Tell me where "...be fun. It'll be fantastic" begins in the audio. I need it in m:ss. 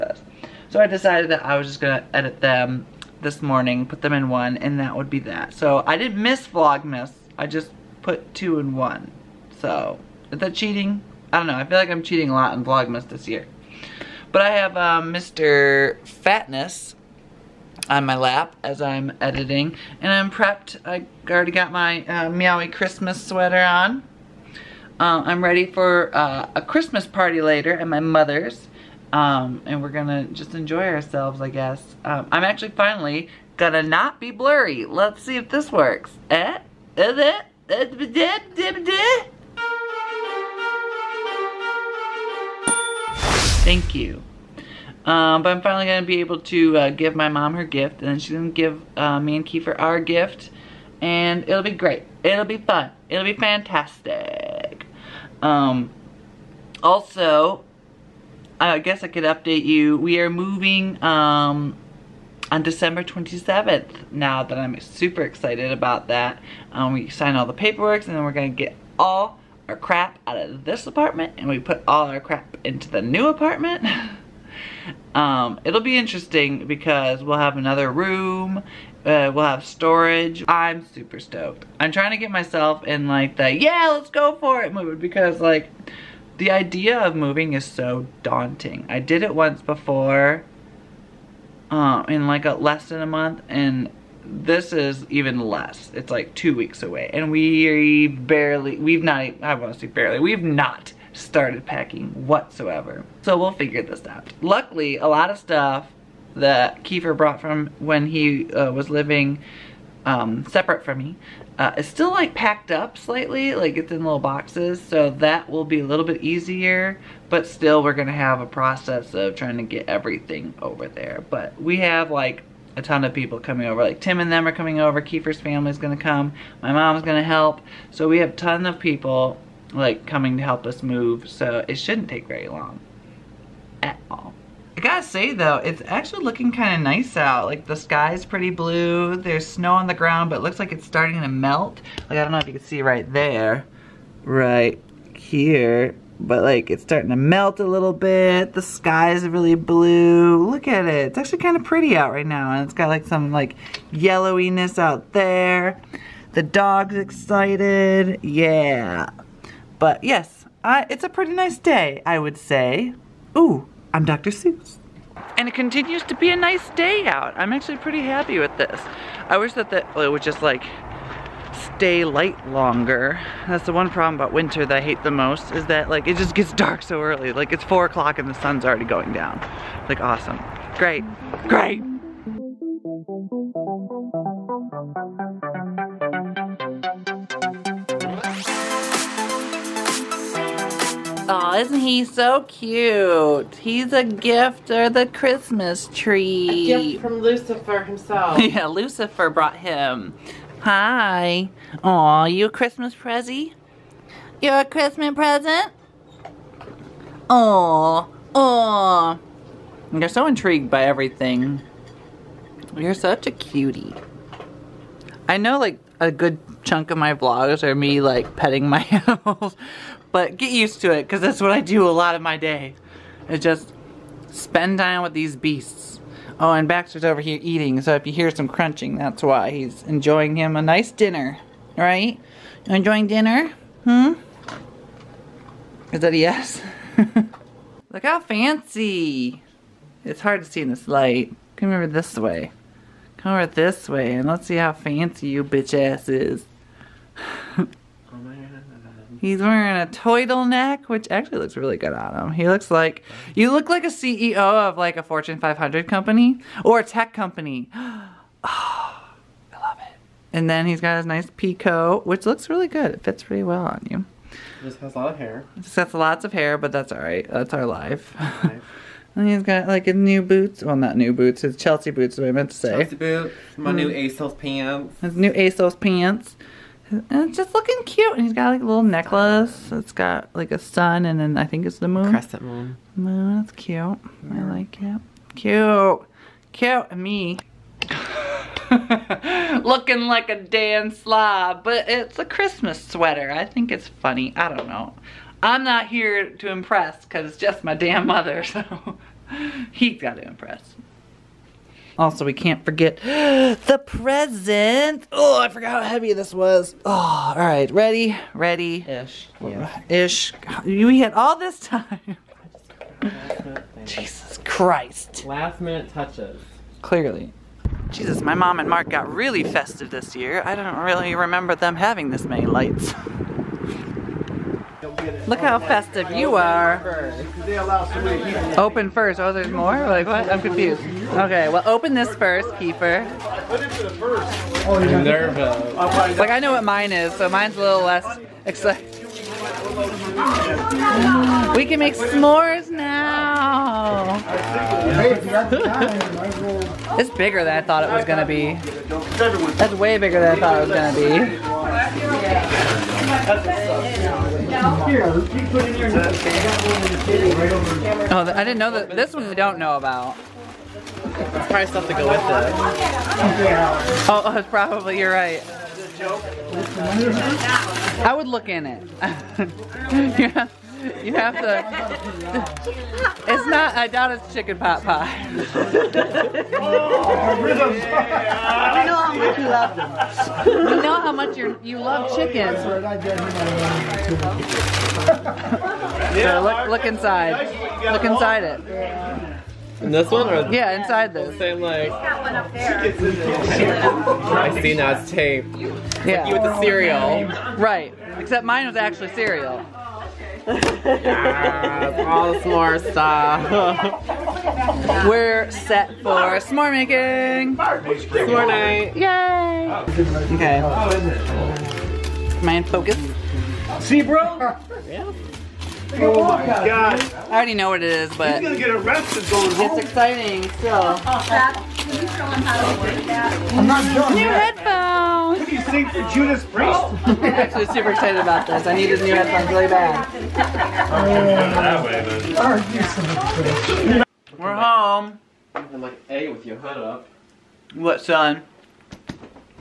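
0:52.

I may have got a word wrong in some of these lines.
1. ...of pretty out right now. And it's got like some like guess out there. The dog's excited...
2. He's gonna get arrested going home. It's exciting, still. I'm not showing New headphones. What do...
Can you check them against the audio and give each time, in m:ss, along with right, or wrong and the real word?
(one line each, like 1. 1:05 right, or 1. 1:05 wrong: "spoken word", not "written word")
1. 2:31 wrong: "yellowiness", not "guess"
2. 6:58 right.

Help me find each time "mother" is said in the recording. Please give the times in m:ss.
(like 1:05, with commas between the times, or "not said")
0:28, 4:58.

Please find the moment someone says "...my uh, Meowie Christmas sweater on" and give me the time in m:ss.
0:21.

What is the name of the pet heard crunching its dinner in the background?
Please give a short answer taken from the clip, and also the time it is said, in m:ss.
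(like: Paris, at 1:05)
Baxter, at 3:46.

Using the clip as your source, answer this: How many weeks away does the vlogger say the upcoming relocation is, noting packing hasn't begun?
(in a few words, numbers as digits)
2.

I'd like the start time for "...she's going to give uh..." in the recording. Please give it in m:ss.
0:48.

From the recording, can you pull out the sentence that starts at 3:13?
He's a gift or the Christmas tree.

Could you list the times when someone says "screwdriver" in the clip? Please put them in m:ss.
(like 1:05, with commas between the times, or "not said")
not said.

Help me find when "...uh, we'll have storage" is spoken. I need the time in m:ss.
1:19.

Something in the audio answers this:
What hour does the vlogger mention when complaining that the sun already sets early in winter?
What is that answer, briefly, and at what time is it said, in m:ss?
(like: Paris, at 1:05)
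4 o'clock, at 2:57.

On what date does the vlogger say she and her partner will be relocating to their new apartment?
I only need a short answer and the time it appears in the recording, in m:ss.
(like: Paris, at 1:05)
December 27, at 1:02.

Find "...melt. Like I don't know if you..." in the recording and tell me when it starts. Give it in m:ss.
2:21.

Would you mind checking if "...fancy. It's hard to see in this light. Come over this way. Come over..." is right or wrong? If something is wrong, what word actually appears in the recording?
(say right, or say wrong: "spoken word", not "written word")
right.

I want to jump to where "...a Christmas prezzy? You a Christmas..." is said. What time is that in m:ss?
3:22.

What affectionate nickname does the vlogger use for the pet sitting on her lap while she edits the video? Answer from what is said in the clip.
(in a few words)
Mr. Fatness.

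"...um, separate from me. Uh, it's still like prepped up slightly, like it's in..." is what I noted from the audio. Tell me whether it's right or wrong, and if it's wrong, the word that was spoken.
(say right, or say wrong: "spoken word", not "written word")
wrong: "packed", not "prepped".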